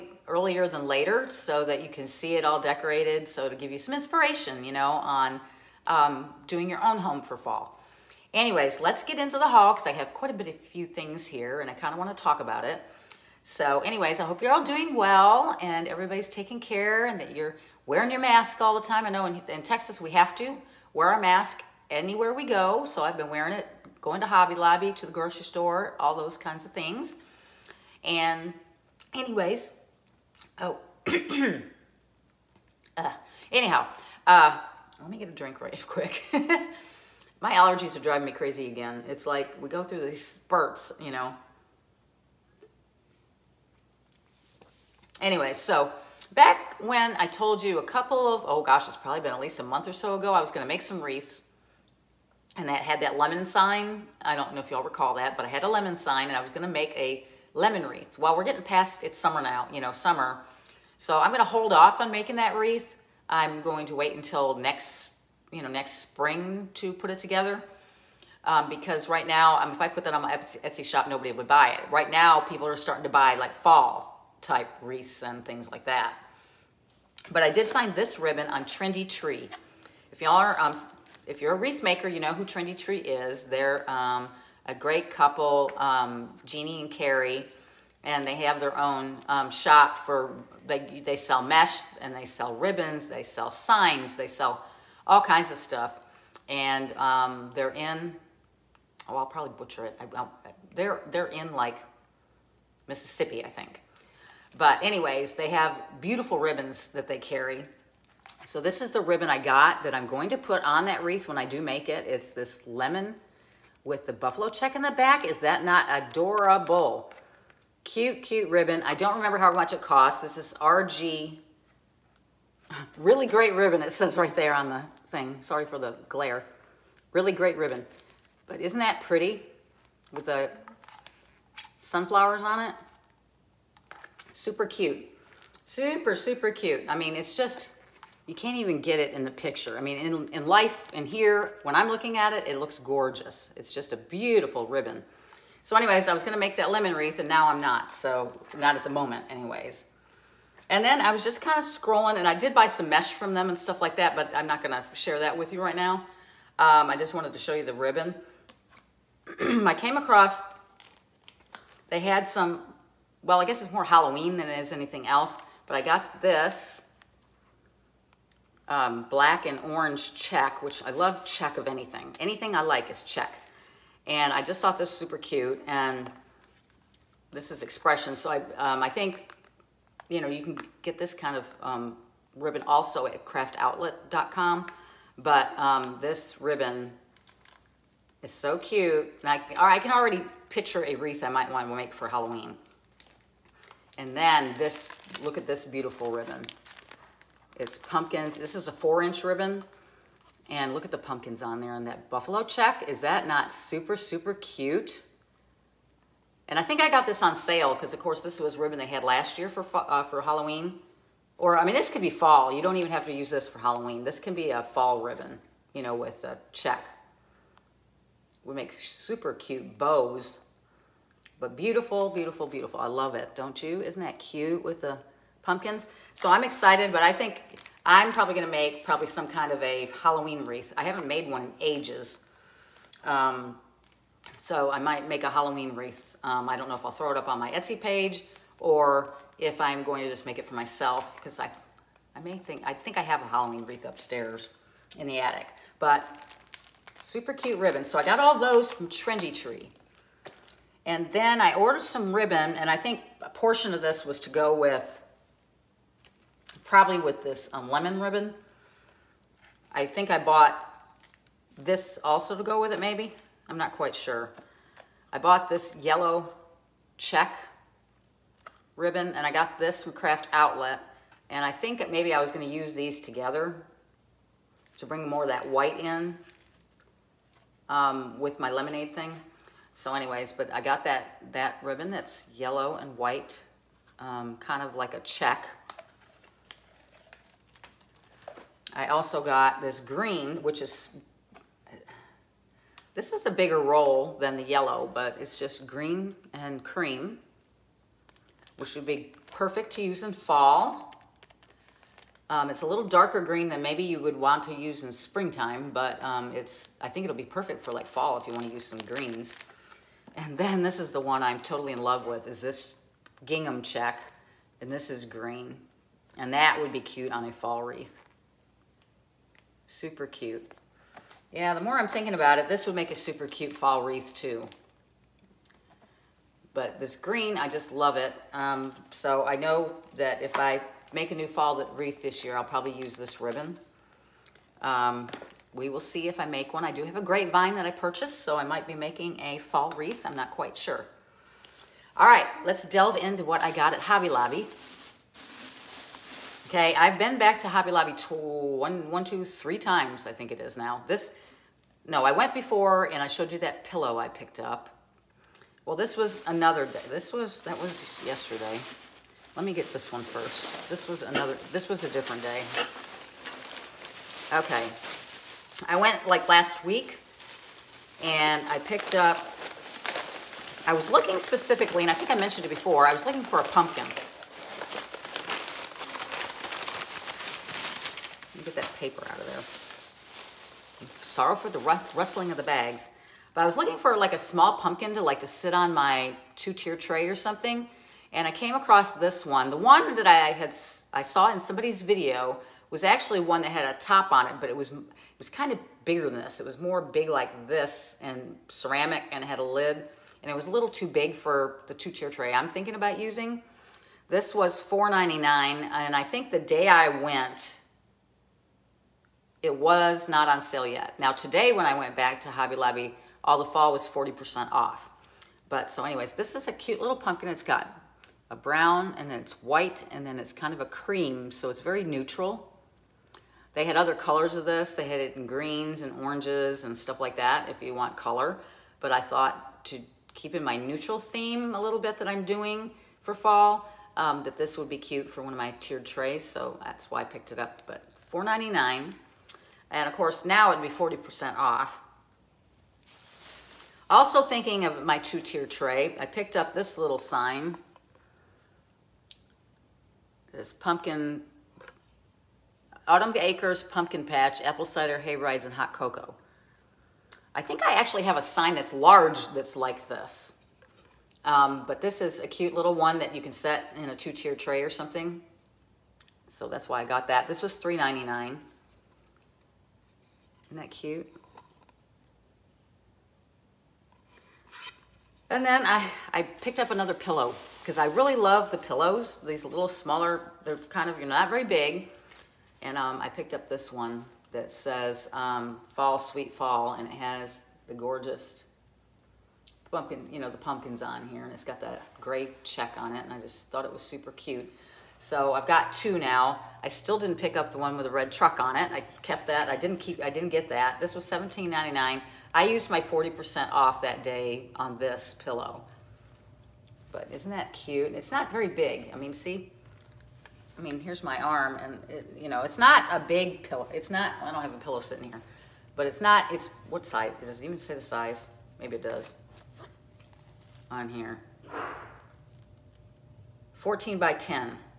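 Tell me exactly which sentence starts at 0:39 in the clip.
It's like we go through these spurts, you know.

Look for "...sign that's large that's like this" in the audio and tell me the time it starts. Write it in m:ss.
7:38.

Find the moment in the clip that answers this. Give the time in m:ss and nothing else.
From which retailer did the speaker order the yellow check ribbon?
4:29.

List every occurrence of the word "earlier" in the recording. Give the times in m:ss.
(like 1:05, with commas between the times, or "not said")
0:00.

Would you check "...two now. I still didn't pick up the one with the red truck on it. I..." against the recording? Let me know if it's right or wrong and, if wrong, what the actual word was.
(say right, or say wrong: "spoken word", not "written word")
right.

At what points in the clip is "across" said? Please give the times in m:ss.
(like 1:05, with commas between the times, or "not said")
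2:39, 6:28.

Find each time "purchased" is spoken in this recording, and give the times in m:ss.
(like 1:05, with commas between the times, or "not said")
5:37.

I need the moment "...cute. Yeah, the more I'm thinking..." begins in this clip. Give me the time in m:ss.
5:20.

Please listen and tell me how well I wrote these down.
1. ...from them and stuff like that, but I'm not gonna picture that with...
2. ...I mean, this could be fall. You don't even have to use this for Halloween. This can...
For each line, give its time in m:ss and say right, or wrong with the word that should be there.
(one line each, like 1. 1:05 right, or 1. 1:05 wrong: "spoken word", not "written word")
1. 2:33 wrong: "share", not "picture"
2. 3:31 right.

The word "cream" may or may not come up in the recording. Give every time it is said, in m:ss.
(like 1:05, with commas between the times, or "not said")
4:56, 7:00.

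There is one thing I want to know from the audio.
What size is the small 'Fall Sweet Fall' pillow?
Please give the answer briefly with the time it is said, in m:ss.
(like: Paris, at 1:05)
14 by 10, at 8:43.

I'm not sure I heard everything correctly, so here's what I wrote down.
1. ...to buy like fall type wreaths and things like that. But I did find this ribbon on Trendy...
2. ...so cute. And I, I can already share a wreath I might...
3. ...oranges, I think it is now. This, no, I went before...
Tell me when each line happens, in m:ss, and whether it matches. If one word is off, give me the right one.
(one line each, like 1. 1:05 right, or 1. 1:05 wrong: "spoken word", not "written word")
1. 1:13 right
2. 3:08 wrong: "picture", not "share"
3. 5:49 wrong: "times", not "oranges".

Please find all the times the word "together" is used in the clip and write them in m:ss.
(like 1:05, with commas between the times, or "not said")
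1:07, 4:33.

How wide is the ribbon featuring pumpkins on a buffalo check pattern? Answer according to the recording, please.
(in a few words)
4 inch.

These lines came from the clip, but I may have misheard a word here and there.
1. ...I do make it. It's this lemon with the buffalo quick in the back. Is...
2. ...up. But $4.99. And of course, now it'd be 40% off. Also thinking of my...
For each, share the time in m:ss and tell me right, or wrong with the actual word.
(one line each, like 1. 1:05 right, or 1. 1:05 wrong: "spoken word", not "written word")
1. 1:51 wrong: "check", not "quick"
2. 7:17 right.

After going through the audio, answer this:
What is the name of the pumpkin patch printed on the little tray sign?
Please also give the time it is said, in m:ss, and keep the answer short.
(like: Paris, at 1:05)
Autumn Acres, at 7:32.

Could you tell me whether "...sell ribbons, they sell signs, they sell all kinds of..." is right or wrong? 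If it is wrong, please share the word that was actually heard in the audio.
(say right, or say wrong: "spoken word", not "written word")
right.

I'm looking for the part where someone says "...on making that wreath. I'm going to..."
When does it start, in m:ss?
1:01.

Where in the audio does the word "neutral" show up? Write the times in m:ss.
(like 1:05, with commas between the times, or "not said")
7:01, 7:10.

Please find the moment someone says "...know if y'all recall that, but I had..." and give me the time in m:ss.
0:54.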